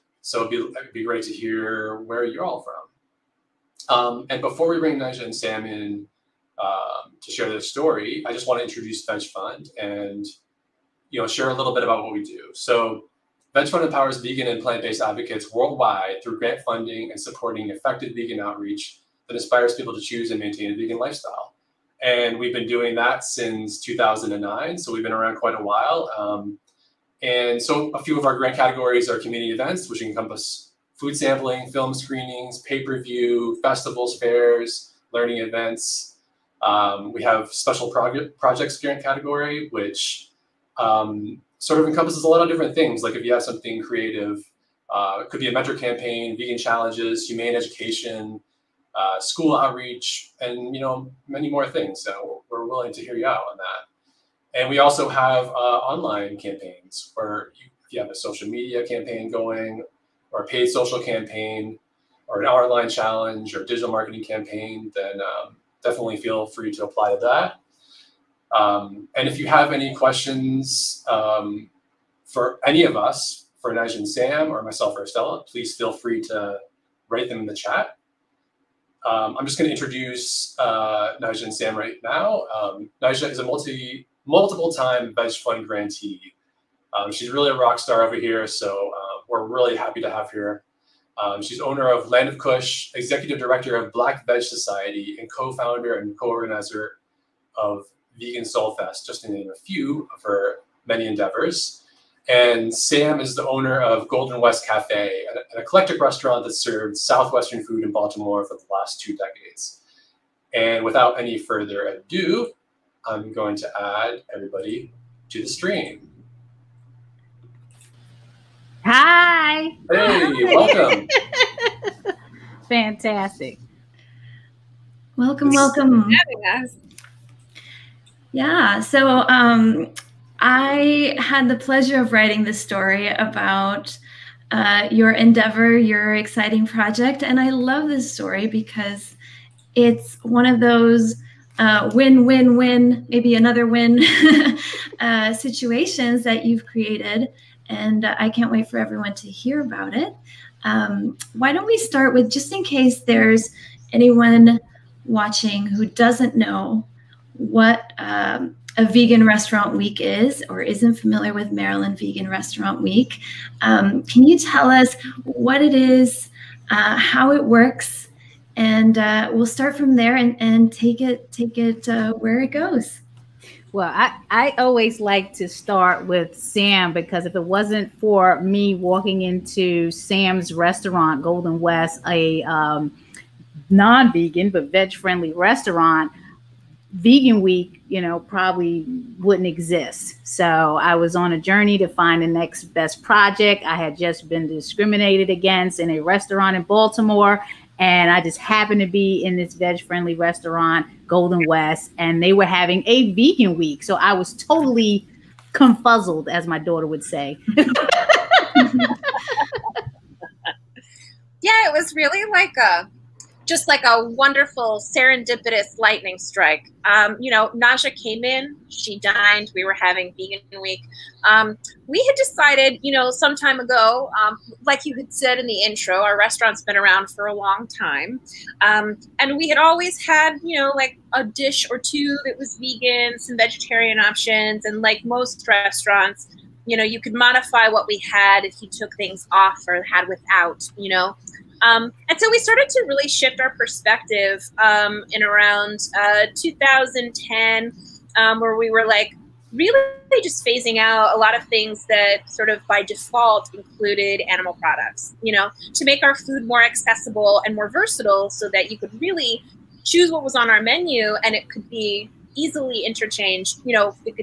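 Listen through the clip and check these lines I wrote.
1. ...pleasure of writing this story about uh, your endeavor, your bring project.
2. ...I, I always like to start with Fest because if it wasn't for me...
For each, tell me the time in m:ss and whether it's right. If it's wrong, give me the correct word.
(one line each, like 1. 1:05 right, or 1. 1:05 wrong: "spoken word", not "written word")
1. 2:11 wrong: "exciting", not "bring"
2. 2:53 wrong: "Sam", not "Fest".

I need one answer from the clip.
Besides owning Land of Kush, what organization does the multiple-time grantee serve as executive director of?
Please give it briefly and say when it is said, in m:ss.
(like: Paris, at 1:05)
Black Veg Society, at 1:33.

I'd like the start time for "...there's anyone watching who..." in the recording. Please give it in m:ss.
2:33.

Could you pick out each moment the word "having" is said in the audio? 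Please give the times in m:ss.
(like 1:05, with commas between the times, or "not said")
3:22, 3:39.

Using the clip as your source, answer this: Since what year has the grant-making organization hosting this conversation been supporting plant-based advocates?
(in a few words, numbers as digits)
2009.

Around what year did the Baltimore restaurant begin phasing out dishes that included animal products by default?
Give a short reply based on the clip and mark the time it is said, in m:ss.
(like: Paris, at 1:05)
2010, at 4:06.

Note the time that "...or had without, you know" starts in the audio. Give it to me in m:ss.
3:59.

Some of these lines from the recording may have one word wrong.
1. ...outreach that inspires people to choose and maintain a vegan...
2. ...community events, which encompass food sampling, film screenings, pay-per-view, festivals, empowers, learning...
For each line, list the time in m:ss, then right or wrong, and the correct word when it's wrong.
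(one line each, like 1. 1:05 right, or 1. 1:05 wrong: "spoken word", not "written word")
1. 0:18 right
2. 0:29 wrong: "fairs", not "empowers".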